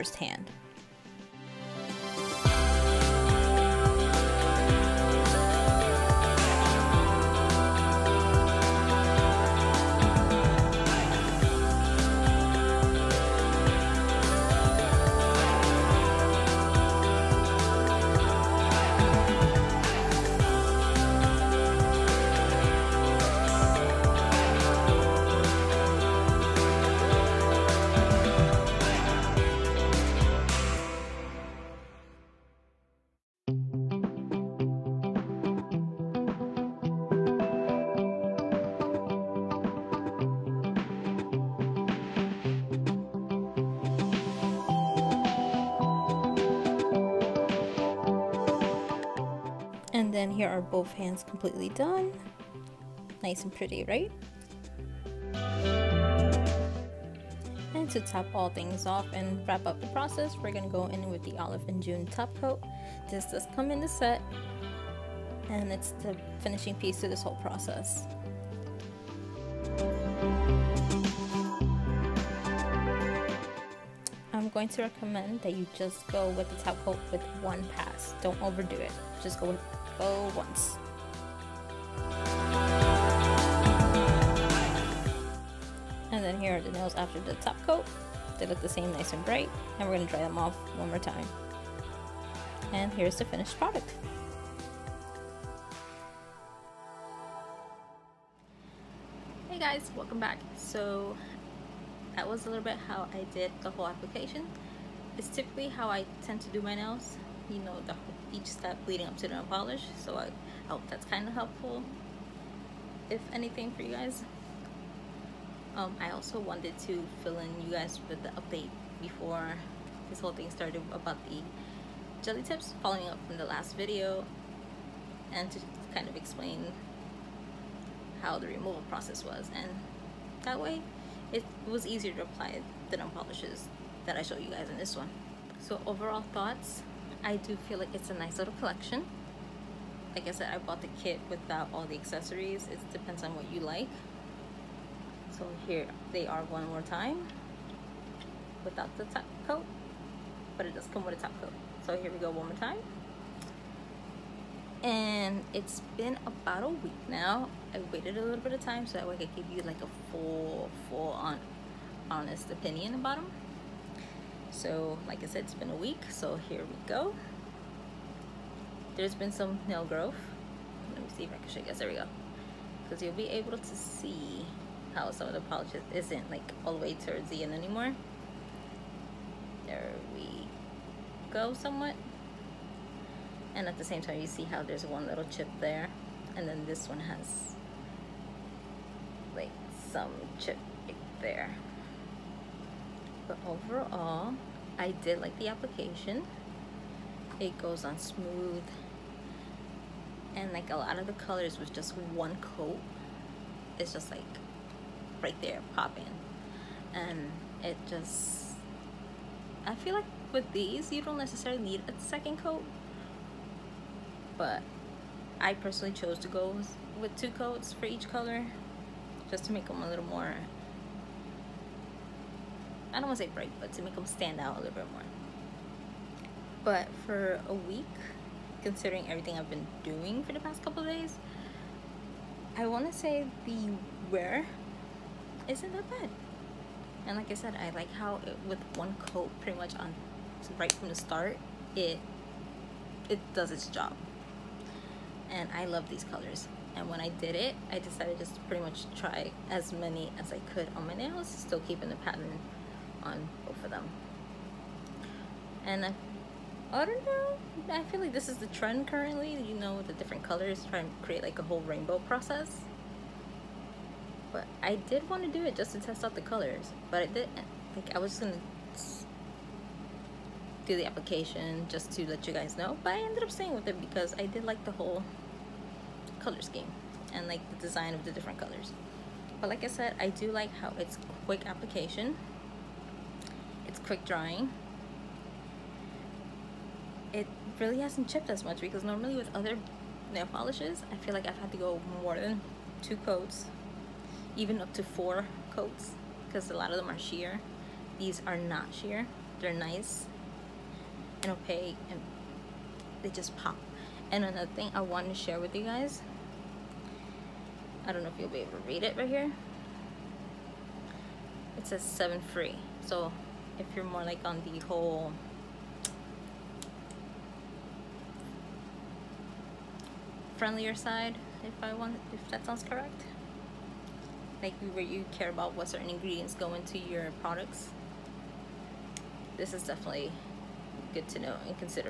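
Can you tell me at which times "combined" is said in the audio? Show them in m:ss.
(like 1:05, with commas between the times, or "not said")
not said.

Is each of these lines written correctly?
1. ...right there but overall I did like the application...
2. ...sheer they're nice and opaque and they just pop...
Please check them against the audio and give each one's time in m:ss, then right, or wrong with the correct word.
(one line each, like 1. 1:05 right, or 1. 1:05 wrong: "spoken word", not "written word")
1. 3:10 right
2. 4:58 right.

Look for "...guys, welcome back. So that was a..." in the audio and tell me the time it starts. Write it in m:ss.
1:39.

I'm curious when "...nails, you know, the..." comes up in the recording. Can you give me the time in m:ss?
1:46.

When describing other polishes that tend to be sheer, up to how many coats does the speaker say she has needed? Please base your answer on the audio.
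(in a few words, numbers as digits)
4.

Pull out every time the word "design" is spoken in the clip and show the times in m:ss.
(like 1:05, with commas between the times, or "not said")
4:37.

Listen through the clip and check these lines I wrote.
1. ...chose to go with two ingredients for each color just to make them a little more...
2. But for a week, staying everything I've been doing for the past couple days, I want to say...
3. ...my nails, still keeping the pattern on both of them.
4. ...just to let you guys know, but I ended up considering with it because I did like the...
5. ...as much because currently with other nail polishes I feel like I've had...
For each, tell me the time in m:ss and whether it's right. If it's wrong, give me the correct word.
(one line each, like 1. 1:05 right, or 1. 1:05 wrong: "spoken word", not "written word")
1. 3:35 wrong: "coats", not "ingredients"
2. 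3:46 wrong: "considering", not "staying"
3. 4:10 right
4. 4:31 wrong: "staying", not "considering"
5. 4:48 wrong: "normally", not "currently".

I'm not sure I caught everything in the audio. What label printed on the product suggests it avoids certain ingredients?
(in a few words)
7 free.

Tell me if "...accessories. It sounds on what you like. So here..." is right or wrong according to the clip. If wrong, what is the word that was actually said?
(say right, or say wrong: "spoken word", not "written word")
wrong: "depends", not "sounds".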